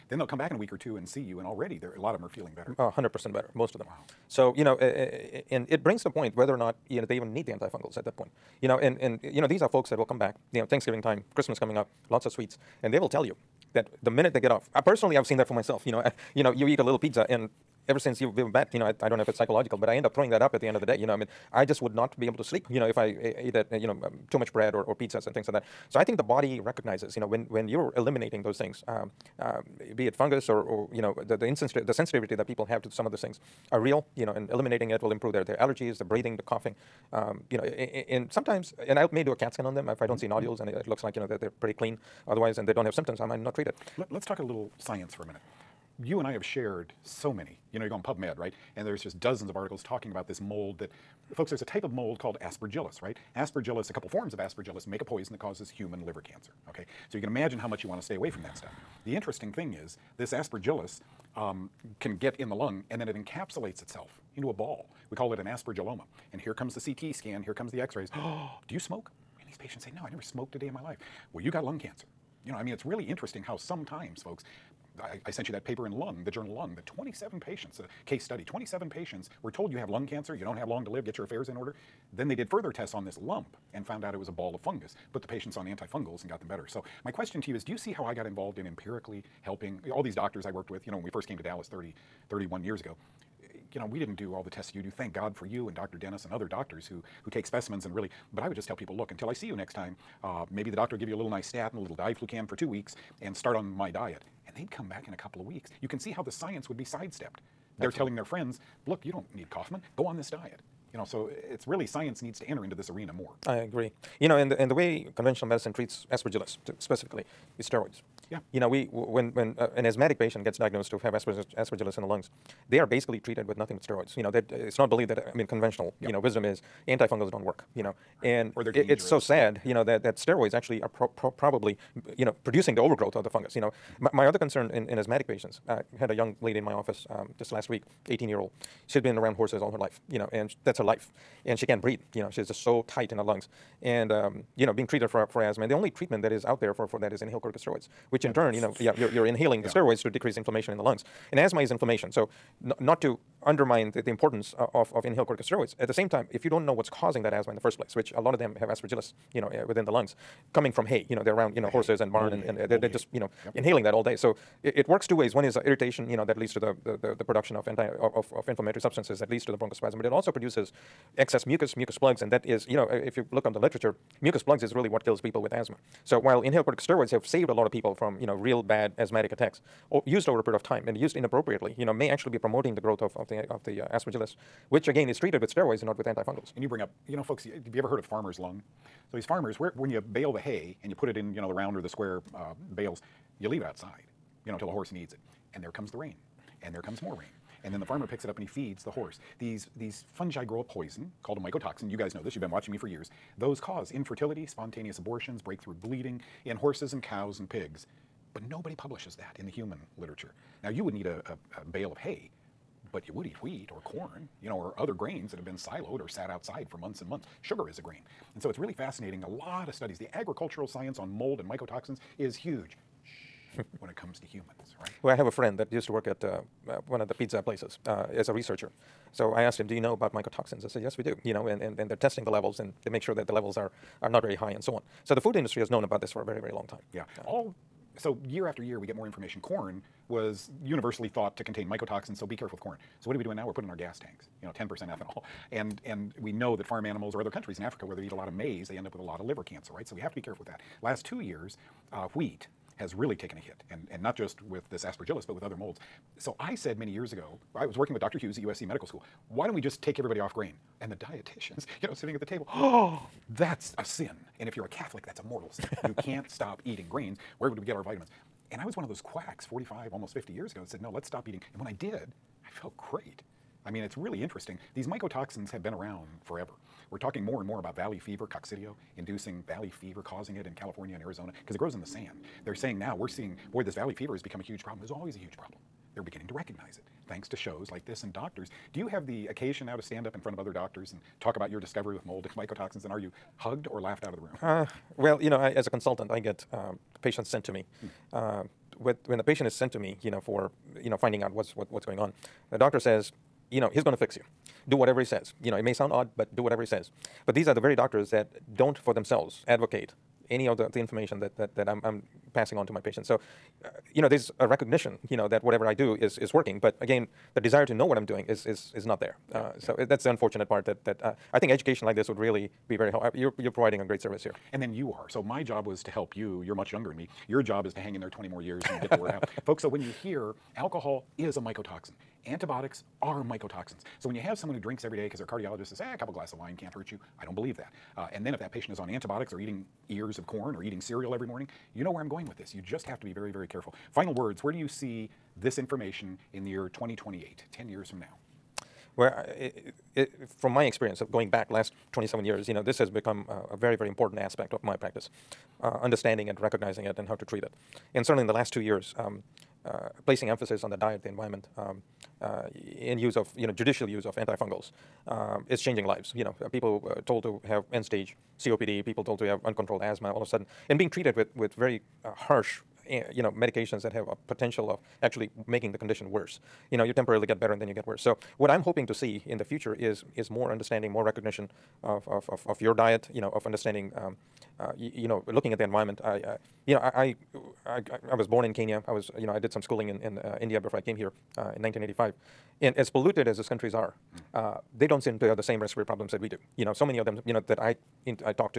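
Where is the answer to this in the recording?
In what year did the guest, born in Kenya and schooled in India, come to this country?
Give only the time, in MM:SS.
06:31.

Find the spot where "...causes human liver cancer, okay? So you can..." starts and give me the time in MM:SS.
00:55.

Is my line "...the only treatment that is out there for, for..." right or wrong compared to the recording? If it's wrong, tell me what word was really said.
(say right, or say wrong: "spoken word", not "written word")
right.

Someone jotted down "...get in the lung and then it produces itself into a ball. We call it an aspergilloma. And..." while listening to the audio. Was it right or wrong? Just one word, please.
wrong.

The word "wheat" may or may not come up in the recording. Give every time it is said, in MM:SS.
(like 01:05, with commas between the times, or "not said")
03:33, 04:12.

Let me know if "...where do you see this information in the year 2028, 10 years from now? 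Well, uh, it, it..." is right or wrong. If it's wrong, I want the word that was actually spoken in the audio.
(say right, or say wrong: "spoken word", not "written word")
right.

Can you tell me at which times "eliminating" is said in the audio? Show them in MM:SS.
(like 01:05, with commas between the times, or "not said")
00:27, 00:34.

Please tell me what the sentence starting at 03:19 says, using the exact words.
These these fungi grow a poison called a mycotoxin.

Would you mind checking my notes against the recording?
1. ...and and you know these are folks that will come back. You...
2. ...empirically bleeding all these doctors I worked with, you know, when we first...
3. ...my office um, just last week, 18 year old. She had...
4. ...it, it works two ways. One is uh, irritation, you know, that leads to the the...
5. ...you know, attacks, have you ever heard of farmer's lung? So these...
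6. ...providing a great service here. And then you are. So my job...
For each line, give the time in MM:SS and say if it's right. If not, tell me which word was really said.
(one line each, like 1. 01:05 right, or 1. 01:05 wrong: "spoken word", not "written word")
1. 00:08 right
2. 01:28 wrong: "helping", not "bleeding"
3. 02:16 right
4. 02:44 right
5. 03:07 wrong: "folks", not "attacks"
6. 05:23 right.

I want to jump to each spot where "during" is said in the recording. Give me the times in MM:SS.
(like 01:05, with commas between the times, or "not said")
not said.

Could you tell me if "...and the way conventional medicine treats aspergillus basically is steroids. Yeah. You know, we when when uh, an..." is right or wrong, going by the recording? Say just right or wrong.
wrong.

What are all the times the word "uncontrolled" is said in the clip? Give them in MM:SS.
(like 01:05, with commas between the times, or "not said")
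06:09.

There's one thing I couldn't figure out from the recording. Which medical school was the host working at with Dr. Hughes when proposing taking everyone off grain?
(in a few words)
USC Medical School.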